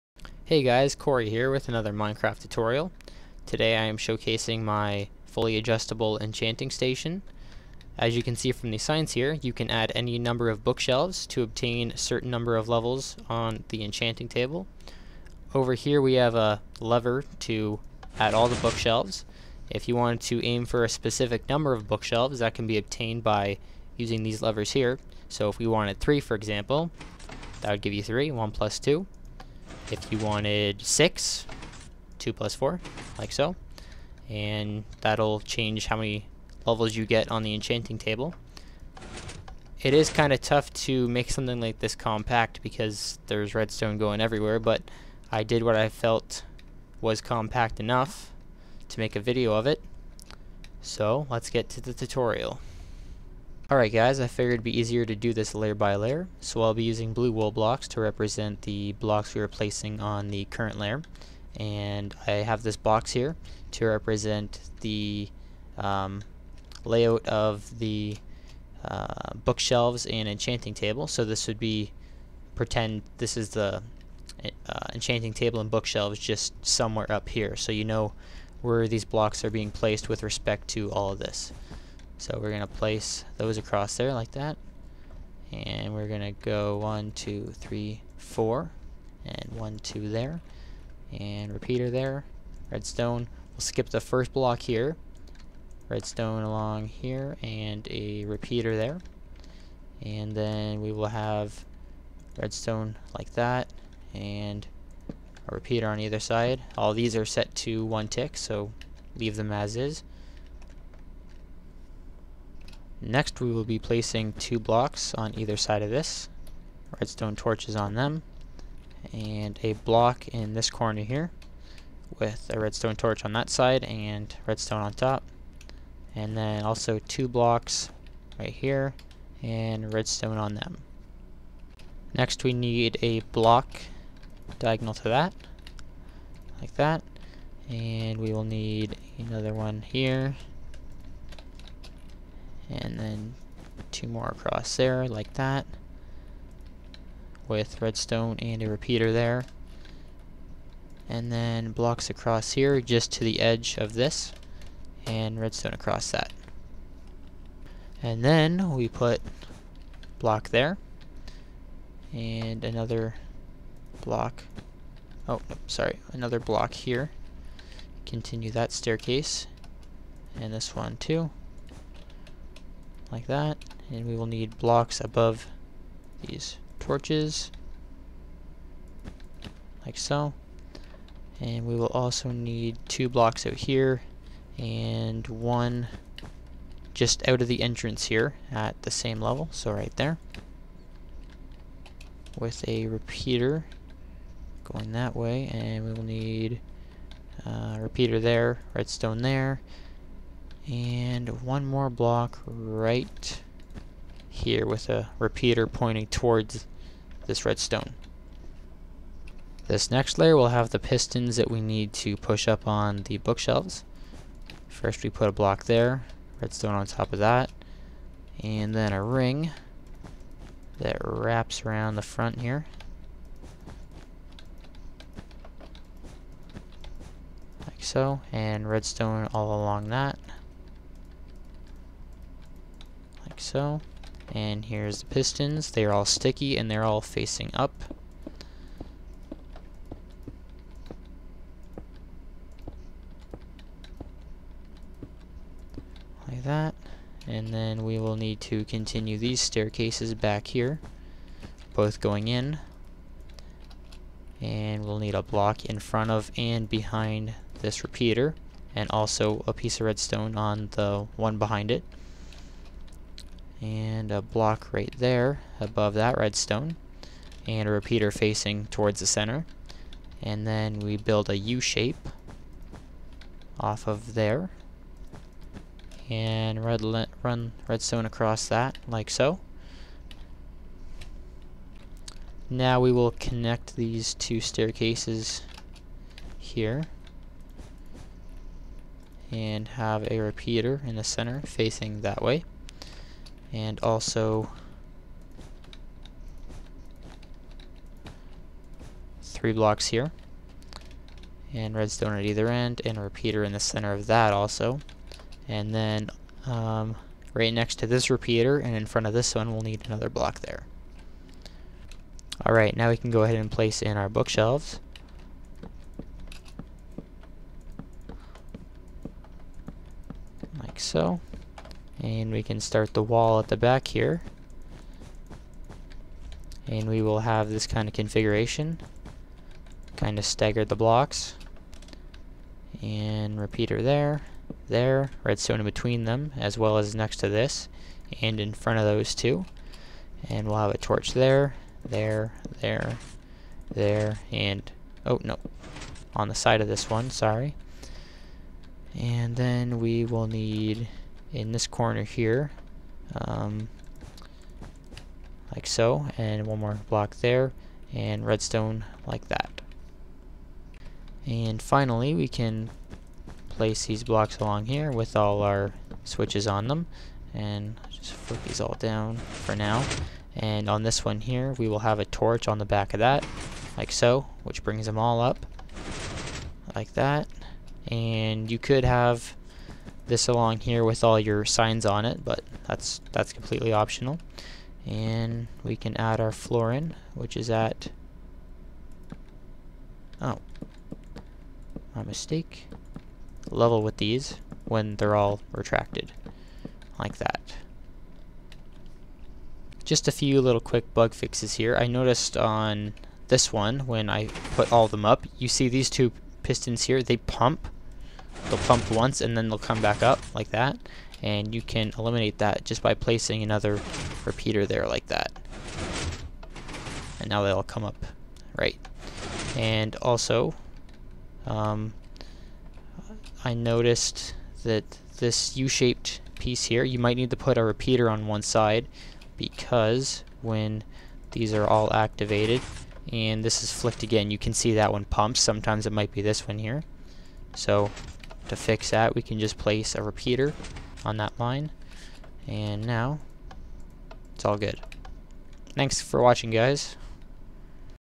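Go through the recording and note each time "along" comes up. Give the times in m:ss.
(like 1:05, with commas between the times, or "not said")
1:36, 3:49, 6:04, 6:20.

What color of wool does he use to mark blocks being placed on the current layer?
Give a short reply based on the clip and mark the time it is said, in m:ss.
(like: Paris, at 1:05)
blue, at 0:57.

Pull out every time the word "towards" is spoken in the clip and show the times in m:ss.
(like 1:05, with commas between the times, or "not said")
3:26, 4:28.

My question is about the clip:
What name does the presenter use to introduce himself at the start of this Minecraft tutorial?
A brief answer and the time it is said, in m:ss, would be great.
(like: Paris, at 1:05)
Cory, at 0:00.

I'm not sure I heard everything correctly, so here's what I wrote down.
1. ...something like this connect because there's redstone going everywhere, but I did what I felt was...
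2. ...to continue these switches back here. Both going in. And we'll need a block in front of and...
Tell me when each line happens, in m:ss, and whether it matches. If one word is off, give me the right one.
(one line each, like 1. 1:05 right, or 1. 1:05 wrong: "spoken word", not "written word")
1. 0:41 wrong: "compact", not "connect"
2. 4:08 wrong: "staircases", not "switches".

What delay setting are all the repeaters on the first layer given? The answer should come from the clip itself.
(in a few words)
one tick.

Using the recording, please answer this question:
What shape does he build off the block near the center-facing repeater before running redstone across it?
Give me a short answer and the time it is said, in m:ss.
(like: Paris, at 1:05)
U shape, at 4:31.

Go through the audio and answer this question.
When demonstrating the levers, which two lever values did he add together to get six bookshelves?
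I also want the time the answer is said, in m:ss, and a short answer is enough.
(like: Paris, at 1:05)
2 plus 4, at 0:32.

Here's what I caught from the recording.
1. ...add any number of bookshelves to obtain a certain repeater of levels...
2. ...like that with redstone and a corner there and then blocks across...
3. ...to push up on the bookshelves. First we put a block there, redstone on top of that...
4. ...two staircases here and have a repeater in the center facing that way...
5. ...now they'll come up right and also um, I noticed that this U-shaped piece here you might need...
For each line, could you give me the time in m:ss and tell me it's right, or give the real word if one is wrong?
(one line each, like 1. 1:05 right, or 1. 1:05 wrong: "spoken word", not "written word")
1. 0:09 wrong: "number", not "repeater"
2. 2:25 wrong: "repeater", not "corner"
3. 3:31 right
4. 4:44 right
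5. 6:57 right.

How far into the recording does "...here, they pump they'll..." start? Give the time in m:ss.
6:46.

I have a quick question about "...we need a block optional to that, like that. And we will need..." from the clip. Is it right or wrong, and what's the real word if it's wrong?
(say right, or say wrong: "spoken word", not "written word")
wrong: "diagonal", not "optional".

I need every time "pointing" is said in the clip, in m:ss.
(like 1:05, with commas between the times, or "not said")
3:25.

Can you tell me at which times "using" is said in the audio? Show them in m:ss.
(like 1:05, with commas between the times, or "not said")
0:23, 0:56.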